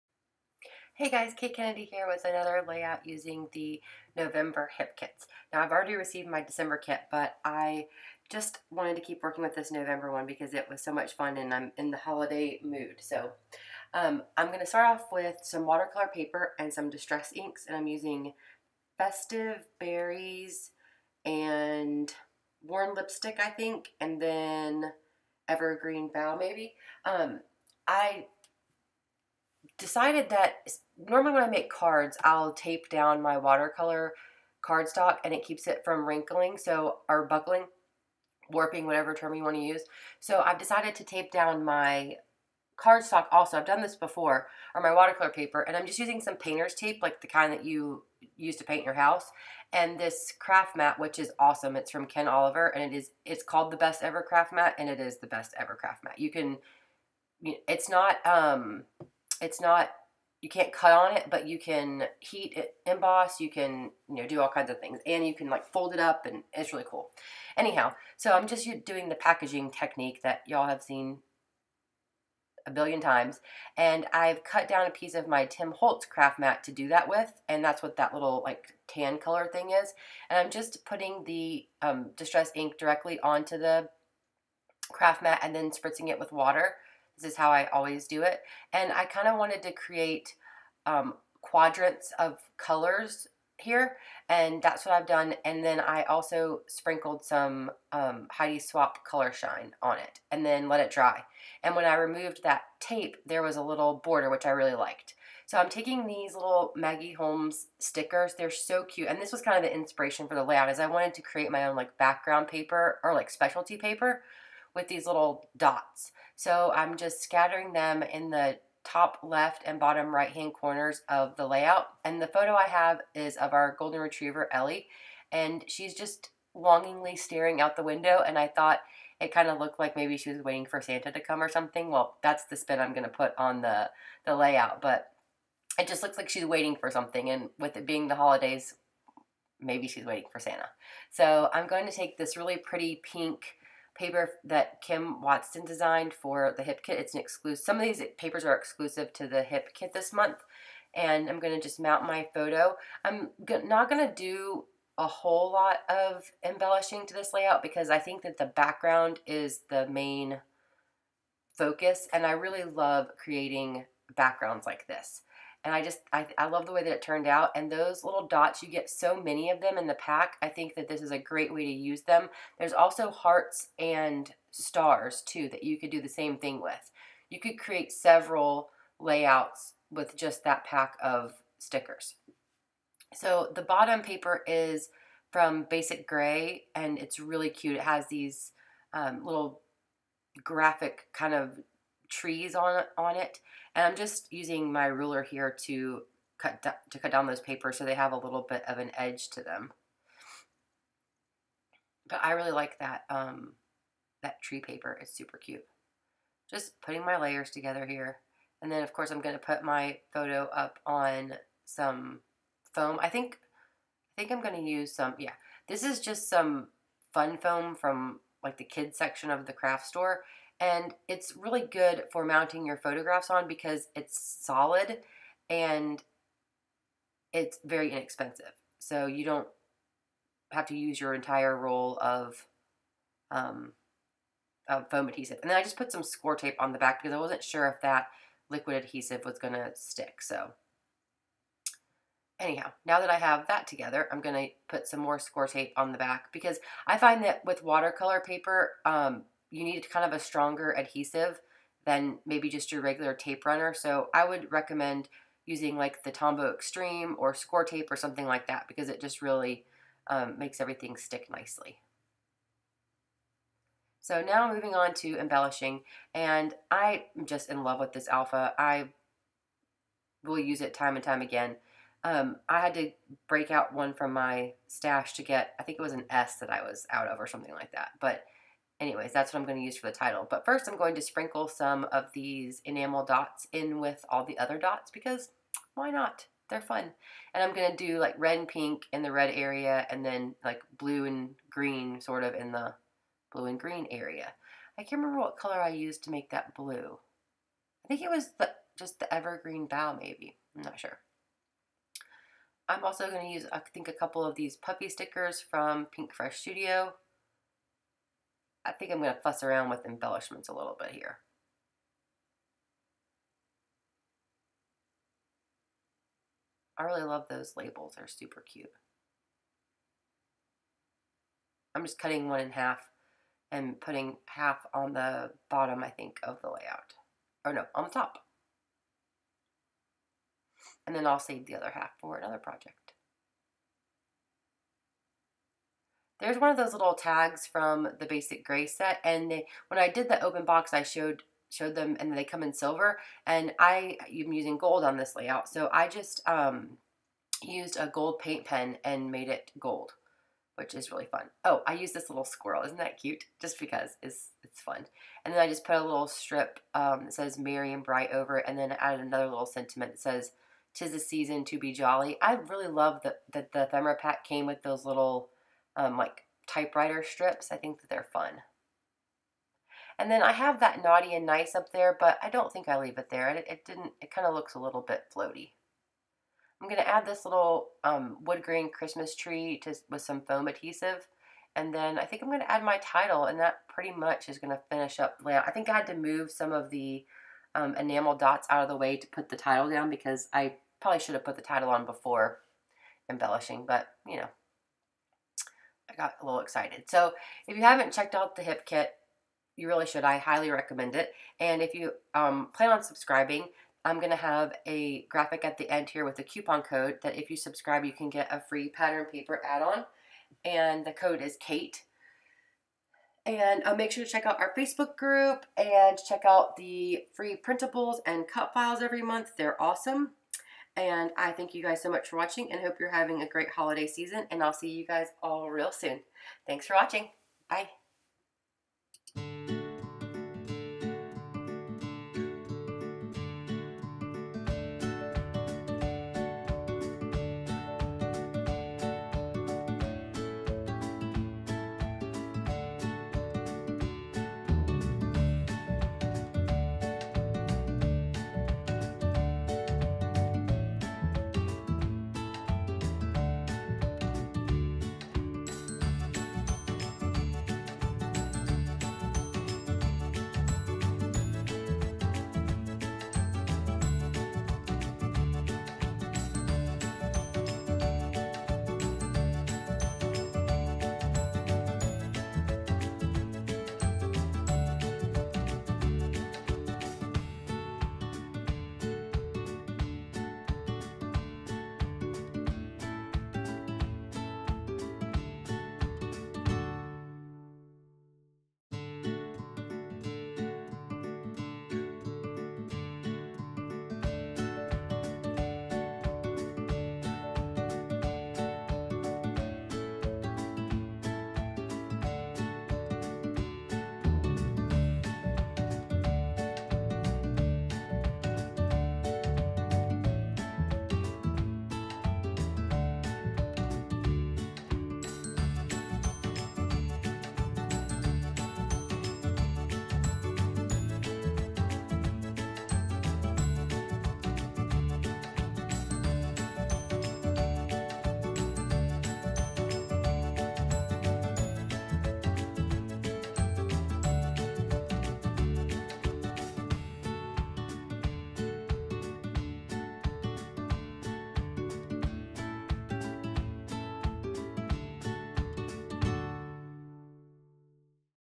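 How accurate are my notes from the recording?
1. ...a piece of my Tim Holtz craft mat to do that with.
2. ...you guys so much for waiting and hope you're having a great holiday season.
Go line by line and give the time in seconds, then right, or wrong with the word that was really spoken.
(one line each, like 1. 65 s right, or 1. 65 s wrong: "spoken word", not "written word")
1. 74 s right
2. 421 s wrong: "watching", not "waiting".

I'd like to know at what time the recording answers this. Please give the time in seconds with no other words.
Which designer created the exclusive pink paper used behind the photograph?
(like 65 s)
144 s.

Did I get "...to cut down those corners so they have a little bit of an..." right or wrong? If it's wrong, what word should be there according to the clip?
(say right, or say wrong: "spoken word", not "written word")
wrong: "papers", not "corners".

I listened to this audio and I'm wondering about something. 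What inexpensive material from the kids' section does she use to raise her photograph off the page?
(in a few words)
Fun foam.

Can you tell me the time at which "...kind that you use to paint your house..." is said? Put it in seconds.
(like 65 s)
47 s.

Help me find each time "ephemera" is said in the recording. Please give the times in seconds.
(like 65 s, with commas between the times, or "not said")
363 s.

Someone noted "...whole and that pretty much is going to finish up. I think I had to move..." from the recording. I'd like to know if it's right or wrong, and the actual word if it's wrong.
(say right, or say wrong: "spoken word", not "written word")
wrong: "title", not "whole".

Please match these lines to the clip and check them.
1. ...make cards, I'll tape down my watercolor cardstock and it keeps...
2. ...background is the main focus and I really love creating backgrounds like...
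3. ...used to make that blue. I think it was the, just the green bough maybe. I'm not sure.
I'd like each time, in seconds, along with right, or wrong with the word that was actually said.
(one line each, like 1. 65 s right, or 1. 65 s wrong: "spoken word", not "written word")
1. 31 s right
2. 158 s right
3. 295 s wrong: "evergreen", not "green".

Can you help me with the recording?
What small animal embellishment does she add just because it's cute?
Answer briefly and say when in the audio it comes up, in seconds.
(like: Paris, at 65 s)
Squirrel, at 352 s.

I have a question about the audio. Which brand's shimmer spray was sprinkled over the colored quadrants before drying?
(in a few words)
Heidi Swapp Color Shine.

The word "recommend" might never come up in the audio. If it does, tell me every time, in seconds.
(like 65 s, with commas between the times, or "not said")
254 s, 400 s.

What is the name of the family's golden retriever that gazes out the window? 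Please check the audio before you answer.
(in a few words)
Ellie.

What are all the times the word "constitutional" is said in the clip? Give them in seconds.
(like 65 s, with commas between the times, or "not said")
not said.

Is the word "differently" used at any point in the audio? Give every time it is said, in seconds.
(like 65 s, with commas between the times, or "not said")
not said.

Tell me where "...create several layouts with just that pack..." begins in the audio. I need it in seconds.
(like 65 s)
177 s.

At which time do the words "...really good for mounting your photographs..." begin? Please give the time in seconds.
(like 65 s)
221 s.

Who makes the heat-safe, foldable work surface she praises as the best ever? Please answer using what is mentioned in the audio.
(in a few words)
Ken Oliver.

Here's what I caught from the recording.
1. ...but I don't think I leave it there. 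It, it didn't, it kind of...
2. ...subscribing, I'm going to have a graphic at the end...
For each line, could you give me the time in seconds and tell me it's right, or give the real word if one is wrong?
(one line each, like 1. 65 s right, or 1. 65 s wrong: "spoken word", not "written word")
1. 371 s right
2. 402 s right.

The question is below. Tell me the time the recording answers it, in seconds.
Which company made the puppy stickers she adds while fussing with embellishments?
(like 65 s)
305 s.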